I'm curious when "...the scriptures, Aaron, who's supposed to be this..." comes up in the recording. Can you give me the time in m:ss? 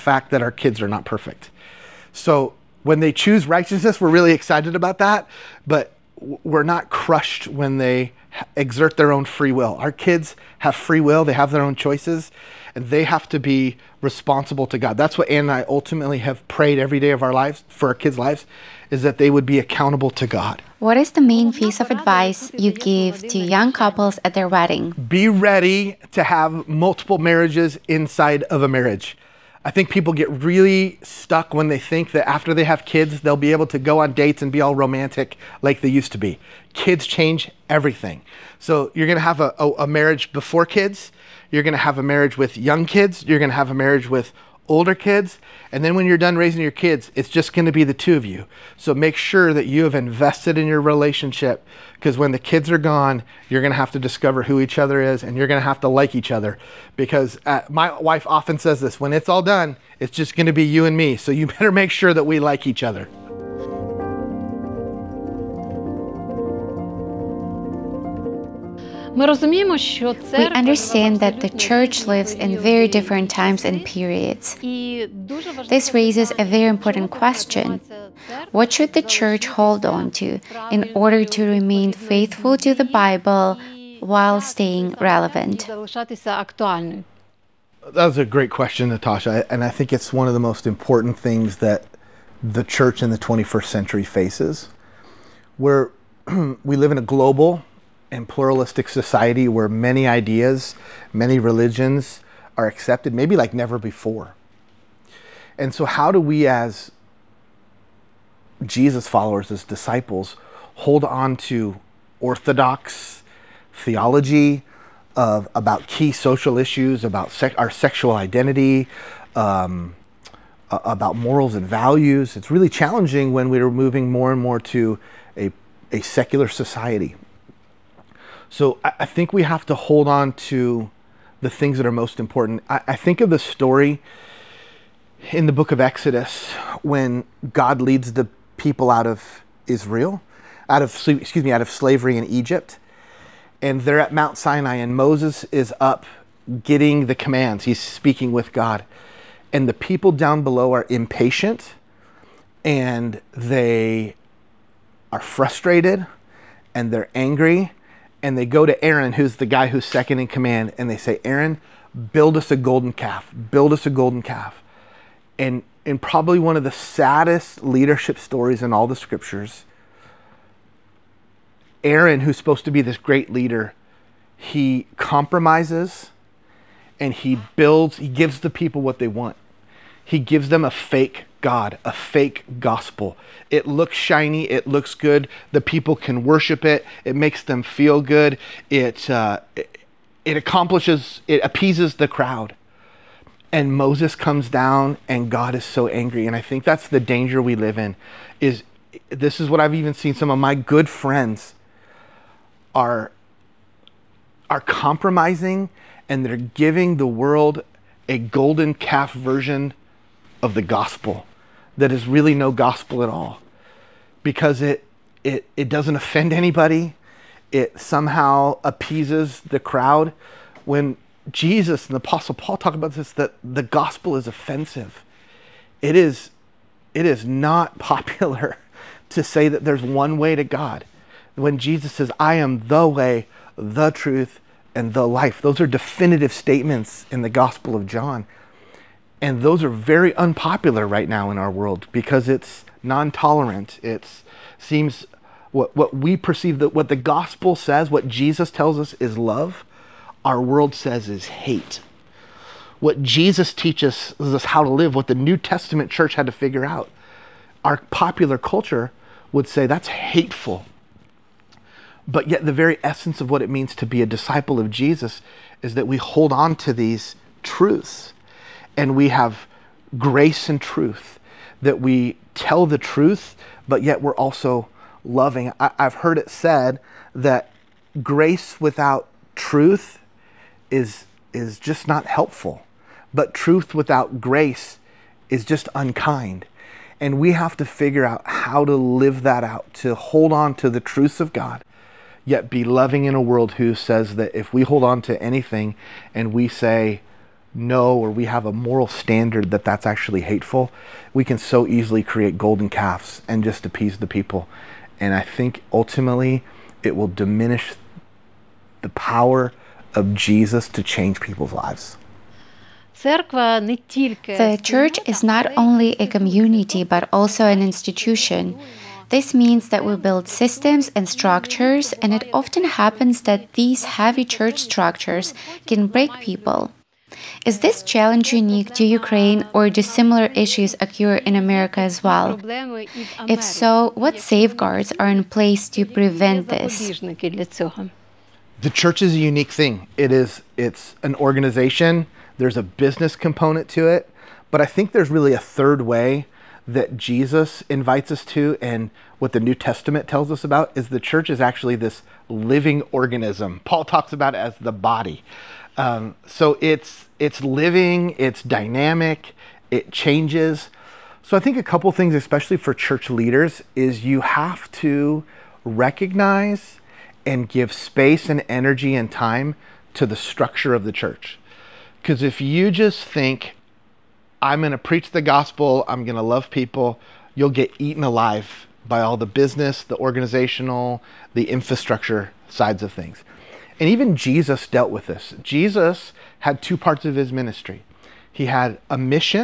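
2:48.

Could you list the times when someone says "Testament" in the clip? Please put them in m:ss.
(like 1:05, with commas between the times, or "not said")
4:15, 5:49.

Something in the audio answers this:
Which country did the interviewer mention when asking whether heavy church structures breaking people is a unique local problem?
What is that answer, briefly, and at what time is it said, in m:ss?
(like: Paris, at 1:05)
Ukraine, at 5:28.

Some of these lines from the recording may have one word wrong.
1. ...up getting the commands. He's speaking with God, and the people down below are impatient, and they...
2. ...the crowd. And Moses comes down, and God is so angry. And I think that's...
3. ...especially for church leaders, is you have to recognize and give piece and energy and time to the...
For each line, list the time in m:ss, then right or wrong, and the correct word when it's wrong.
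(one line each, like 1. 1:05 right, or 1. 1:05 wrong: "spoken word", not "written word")
1. 2:25 right
2. 3:11 right
3. 6:02 wrong: "space", not "piece".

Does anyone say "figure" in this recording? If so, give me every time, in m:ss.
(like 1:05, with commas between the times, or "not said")
4:16, 4:47.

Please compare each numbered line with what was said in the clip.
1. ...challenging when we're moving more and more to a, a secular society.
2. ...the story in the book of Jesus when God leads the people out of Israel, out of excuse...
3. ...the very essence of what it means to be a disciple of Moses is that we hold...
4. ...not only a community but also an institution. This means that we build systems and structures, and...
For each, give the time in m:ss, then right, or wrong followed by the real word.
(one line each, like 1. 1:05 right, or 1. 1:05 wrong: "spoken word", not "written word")
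1. 2:02 right
2. 2:13 wrong: "Exodus", not "Jesus"
3. 4:22 wrong: "Jesus", not "Moses"
4. 5:15 right.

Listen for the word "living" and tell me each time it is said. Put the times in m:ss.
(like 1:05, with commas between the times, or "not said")
5:52, 5:57.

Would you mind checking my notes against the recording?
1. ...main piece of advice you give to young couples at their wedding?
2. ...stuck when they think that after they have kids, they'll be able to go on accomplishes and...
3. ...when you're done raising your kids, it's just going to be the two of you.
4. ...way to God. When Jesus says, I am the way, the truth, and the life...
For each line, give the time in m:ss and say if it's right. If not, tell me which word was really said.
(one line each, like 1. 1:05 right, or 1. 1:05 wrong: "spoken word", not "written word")
1. 0:21 right
2. 0:31 wrong: "dates", not "accomplishes"
3. 0:45 right
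4. 3:50 right.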